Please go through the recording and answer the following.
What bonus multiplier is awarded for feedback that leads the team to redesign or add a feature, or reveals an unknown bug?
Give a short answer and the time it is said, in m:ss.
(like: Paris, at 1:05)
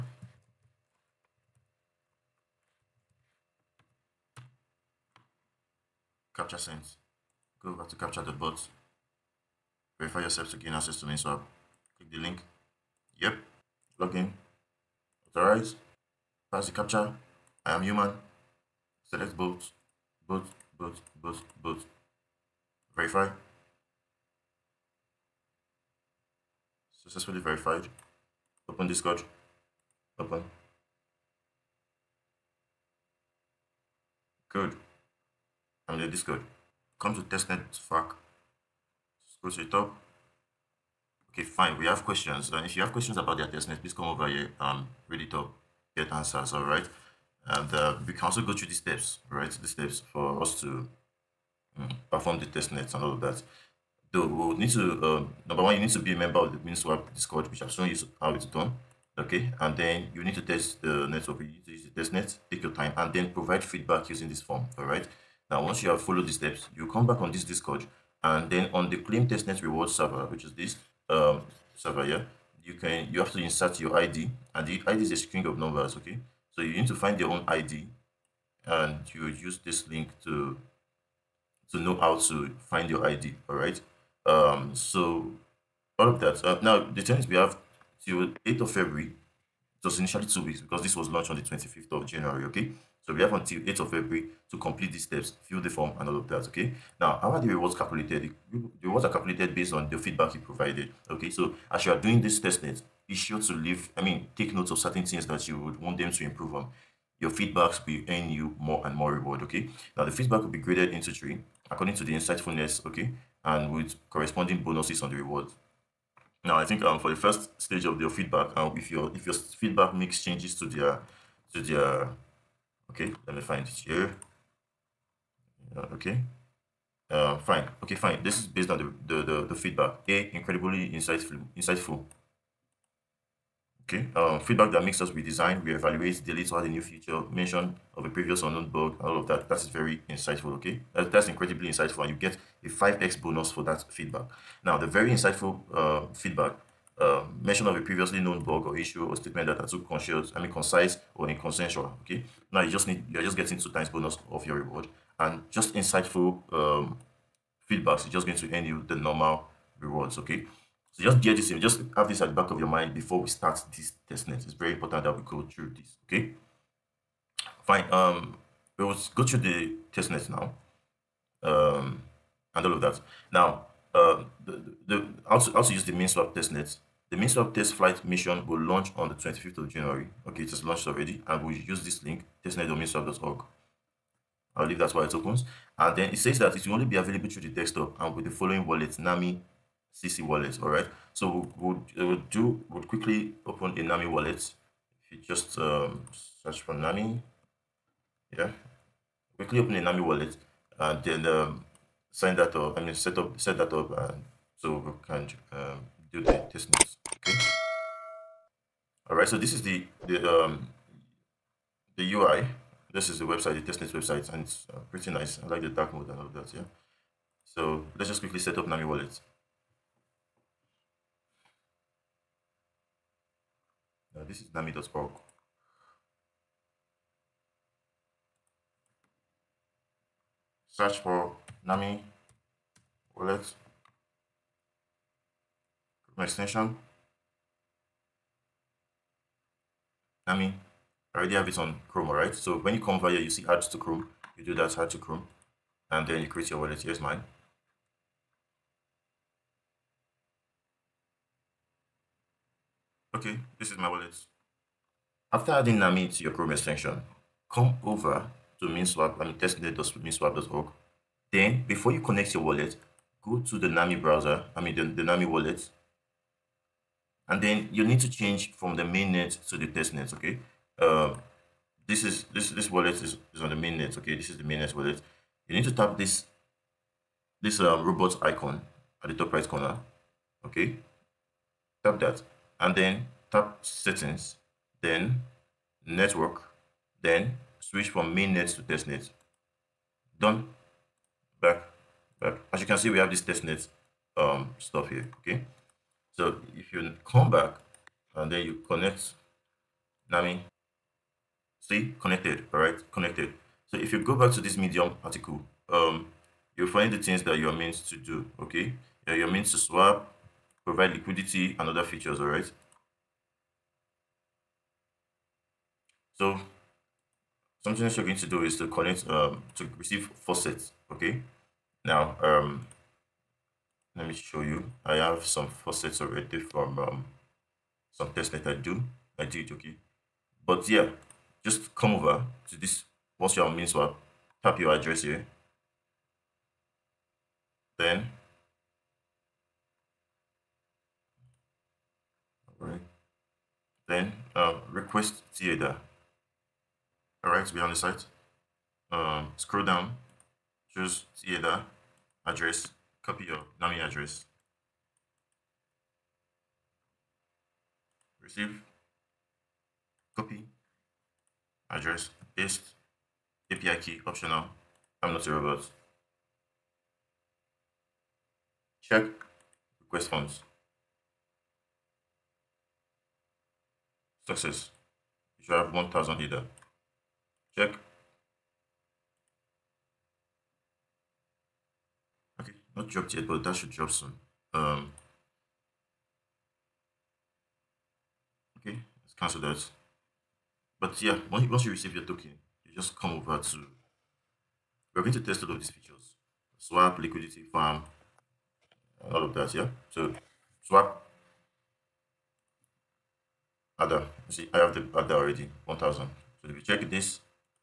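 5x, at 2:22.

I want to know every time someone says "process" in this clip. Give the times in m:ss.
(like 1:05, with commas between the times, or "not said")
not said.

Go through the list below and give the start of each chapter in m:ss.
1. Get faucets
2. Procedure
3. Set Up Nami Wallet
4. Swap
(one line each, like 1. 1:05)
1. 5:04
2. 0:53
3. 3:04
4. 6:31.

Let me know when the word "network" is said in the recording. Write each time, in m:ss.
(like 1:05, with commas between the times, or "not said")
1:01, 4:45.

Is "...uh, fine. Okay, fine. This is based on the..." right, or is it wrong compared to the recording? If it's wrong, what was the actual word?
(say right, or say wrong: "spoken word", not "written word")
right.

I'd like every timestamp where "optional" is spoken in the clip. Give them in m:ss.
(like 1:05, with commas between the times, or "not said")
6:04.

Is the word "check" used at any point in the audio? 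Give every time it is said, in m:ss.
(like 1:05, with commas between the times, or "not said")
6:08, 6:17, 6:46.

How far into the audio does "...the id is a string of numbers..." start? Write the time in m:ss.
1:14.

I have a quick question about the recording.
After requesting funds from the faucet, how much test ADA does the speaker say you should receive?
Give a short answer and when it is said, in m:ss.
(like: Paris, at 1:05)
1000 ADA, at 6:15.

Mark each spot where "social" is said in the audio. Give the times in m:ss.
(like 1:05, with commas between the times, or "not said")
not said.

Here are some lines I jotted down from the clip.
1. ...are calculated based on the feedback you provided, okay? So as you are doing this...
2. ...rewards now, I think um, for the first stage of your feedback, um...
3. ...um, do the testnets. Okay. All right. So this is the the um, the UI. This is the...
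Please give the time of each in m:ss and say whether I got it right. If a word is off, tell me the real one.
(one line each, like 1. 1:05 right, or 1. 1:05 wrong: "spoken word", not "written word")
1. 1:39 right
2. 1:55 right
3. 3:25 right.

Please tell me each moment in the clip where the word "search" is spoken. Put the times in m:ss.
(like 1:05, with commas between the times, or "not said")
3:16, 3:50.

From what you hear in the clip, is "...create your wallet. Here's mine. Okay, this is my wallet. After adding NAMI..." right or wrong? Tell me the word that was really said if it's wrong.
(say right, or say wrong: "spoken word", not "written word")
right.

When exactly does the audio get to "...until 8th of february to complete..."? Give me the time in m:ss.
1:33.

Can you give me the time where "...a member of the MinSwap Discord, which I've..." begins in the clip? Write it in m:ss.
0:56.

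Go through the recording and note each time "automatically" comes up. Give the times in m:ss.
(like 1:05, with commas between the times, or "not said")
not said.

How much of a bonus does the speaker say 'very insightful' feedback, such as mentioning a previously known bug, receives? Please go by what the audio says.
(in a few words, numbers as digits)
two times.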